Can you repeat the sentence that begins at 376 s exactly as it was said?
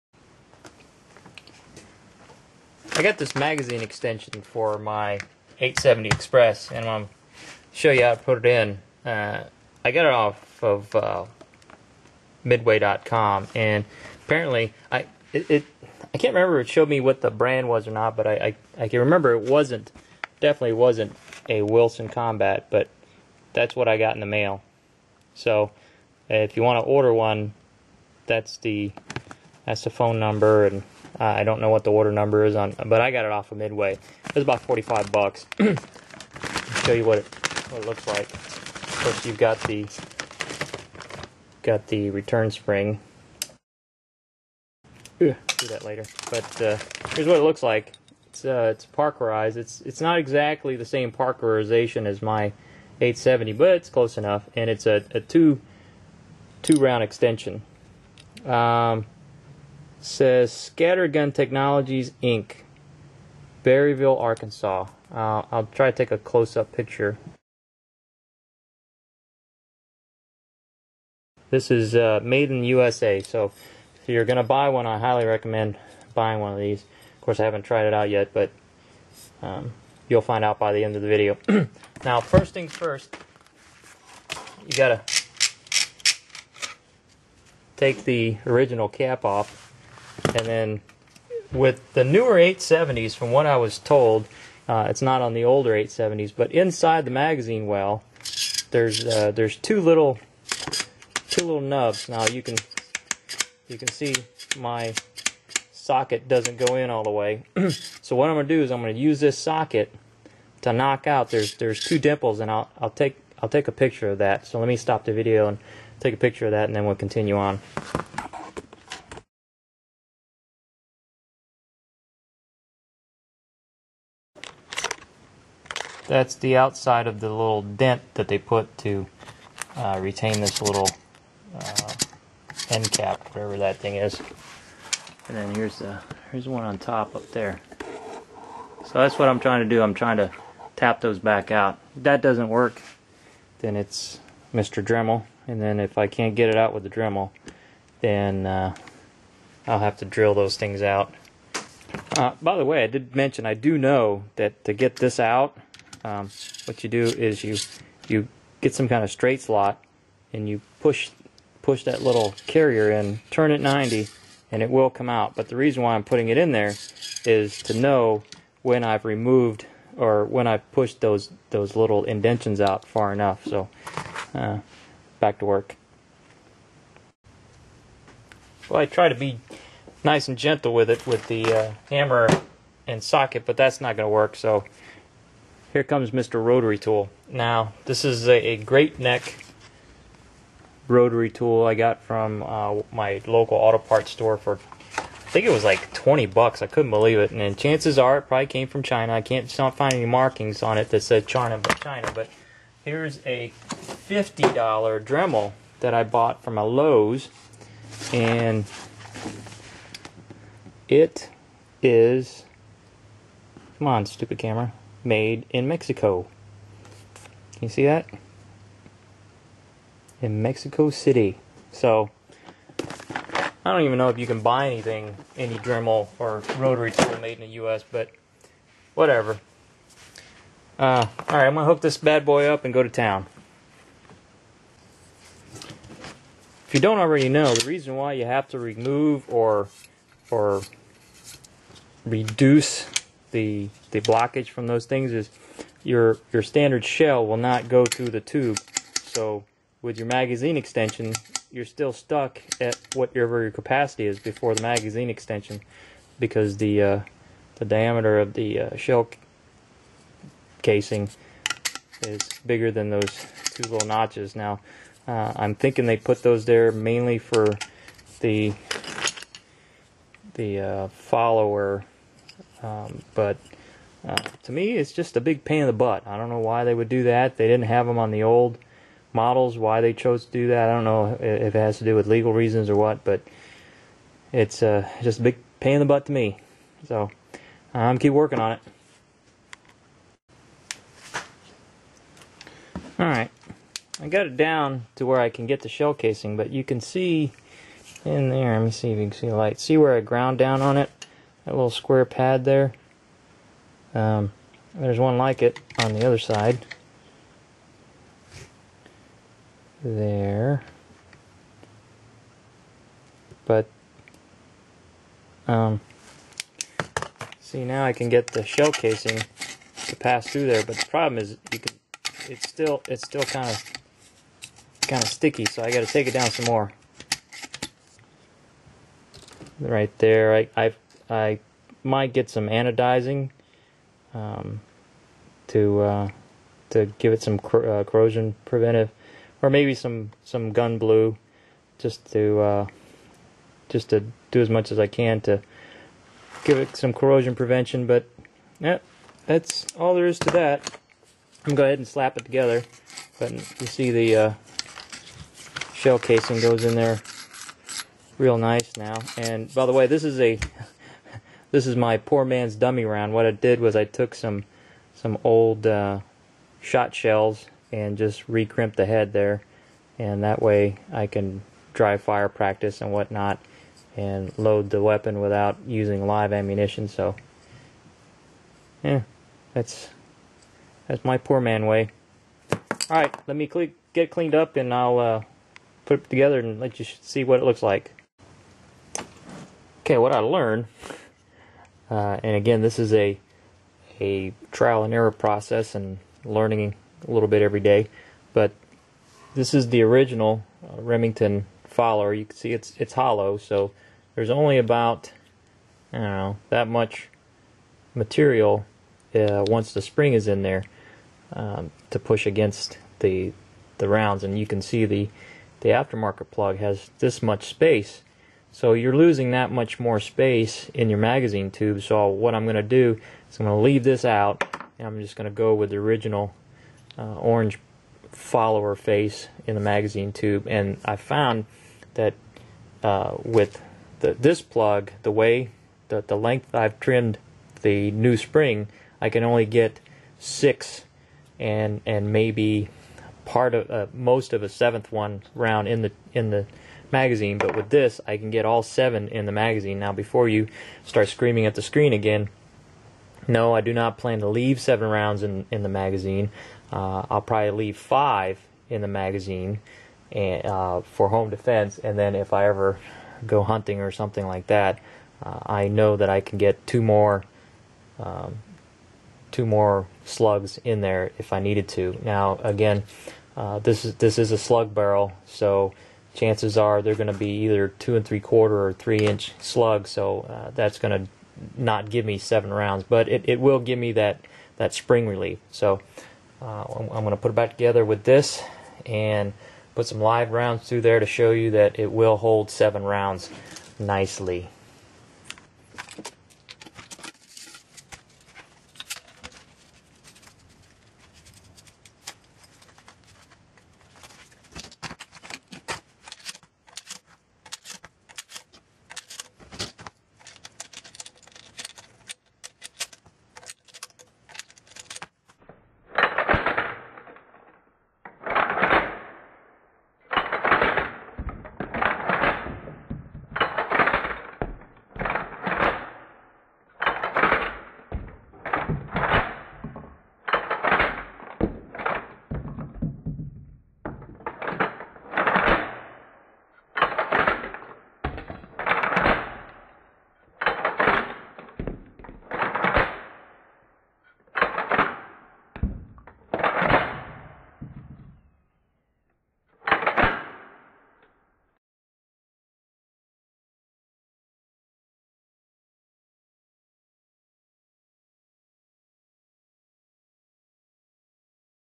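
So, yeah, that's that's my poor man way.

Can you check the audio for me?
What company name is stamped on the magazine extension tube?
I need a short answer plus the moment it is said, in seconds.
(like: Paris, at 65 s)
Scattergun Technologies Inc., at 60 s.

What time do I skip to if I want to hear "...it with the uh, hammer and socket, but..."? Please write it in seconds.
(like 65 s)
180 s.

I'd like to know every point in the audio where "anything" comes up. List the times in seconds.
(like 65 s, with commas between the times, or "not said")
224 s.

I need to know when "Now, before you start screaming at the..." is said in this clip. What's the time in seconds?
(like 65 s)
449 s.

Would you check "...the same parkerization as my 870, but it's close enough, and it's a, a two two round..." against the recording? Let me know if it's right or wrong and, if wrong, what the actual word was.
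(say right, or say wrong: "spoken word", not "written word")
right.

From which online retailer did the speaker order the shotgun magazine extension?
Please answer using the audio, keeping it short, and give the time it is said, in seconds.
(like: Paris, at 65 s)
Midway.com, at 12 s.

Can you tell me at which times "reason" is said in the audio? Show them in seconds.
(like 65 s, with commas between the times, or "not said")
165 s, 237 s, 282 s.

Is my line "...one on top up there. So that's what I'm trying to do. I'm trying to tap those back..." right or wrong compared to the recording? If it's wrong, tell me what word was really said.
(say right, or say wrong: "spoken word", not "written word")
right.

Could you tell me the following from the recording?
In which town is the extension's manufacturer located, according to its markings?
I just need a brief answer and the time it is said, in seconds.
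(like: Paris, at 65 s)
Berryville, Arkansas, at 63 s.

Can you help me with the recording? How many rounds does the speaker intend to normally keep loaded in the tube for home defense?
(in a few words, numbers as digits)
5.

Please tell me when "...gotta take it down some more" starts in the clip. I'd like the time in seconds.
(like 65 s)
325 s.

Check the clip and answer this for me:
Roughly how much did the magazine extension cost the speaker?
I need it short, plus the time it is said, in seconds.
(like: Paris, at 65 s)
45 bucks, at 34 s.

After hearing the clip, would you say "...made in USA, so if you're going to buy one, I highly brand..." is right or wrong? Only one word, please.
wrong.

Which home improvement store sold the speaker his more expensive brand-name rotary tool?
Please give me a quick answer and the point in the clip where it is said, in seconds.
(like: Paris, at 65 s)
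Lowe's, at 206 s.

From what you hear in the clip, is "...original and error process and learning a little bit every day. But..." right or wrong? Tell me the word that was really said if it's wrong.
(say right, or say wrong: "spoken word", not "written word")
wrong: "trial", not "original".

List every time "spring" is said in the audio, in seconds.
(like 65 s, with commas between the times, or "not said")
42 s, 409 s, 438 s, 484 s.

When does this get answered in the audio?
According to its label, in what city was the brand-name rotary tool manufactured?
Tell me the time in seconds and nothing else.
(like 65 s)
220 s.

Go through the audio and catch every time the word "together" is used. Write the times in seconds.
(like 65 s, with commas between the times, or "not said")
352 s, 386 s, 487 s.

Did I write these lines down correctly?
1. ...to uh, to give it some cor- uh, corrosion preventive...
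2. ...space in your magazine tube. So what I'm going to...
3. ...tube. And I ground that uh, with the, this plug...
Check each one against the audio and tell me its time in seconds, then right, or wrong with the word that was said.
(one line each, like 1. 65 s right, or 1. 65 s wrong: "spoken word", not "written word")
1. 335 s right
2. 420 s right
3. 430 s wrong: "found", not "ground".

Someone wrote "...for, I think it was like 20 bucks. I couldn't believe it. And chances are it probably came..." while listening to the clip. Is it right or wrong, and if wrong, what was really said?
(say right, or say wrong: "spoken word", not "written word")
right.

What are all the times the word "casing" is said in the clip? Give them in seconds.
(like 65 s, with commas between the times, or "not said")
260 s, 295 s, 318 s, 355 s.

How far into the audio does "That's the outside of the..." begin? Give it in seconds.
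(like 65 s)
126 s.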